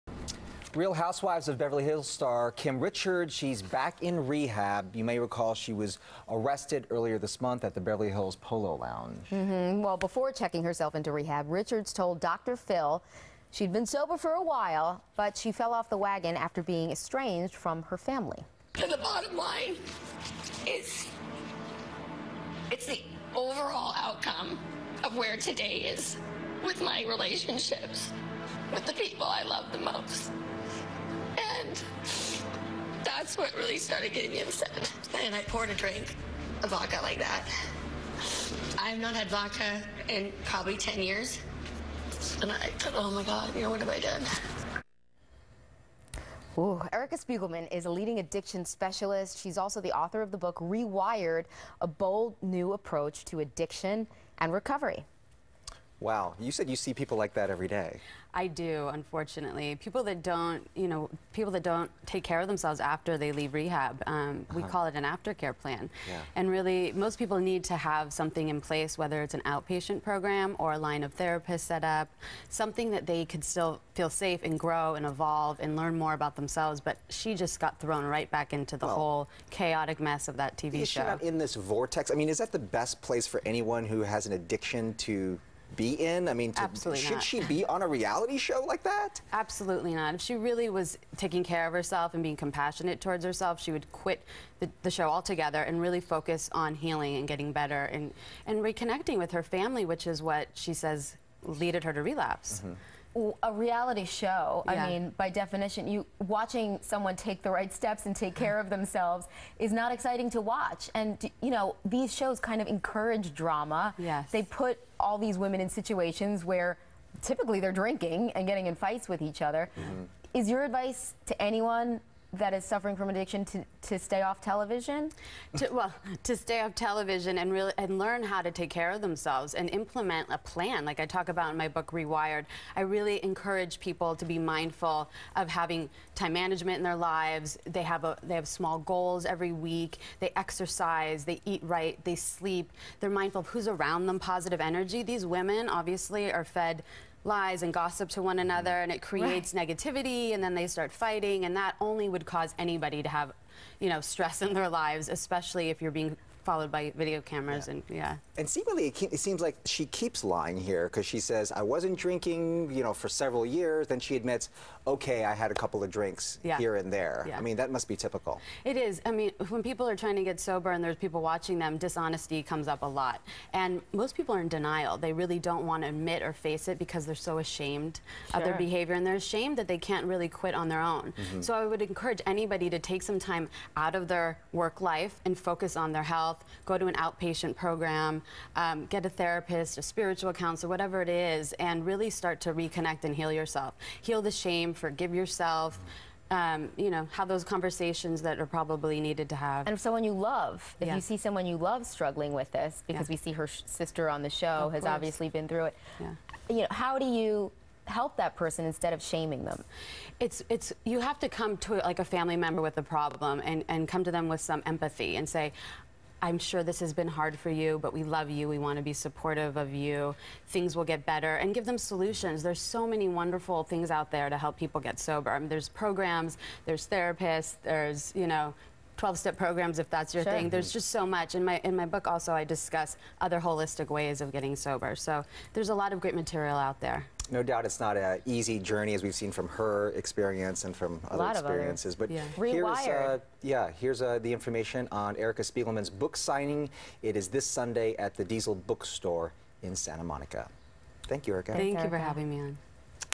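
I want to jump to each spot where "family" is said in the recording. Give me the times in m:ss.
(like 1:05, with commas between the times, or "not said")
0:17, 1:39, 3:32.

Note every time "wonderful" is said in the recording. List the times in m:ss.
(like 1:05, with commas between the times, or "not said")
3:43.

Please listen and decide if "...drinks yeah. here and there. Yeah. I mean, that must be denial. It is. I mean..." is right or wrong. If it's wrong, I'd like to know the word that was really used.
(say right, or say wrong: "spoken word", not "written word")
wrong: "typical", not "denial".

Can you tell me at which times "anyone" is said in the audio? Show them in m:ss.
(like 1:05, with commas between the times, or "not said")
1:23, 2:01.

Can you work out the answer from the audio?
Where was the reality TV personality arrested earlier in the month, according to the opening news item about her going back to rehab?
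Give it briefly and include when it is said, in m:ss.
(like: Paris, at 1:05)
Beverly Hills Polo Lounge, at 0:07.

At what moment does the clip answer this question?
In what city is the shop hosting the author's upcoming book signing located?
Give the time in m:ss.
4:09.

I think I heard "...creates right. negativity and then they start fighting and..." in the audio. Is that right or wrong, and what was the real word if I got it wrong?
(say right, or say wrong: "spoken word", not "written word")
right.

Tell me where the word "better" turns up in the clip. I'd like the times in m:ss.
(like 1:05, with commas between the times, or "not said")
1:37, 3:41.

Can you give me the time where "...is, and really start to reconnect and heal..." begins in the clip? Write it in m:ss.
3:11.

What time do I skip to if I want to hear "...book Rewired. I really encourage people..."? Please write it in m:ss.
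2:11.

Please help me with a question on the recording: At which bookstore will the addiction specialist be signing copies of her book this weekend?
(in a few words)
Diesel Bookstore.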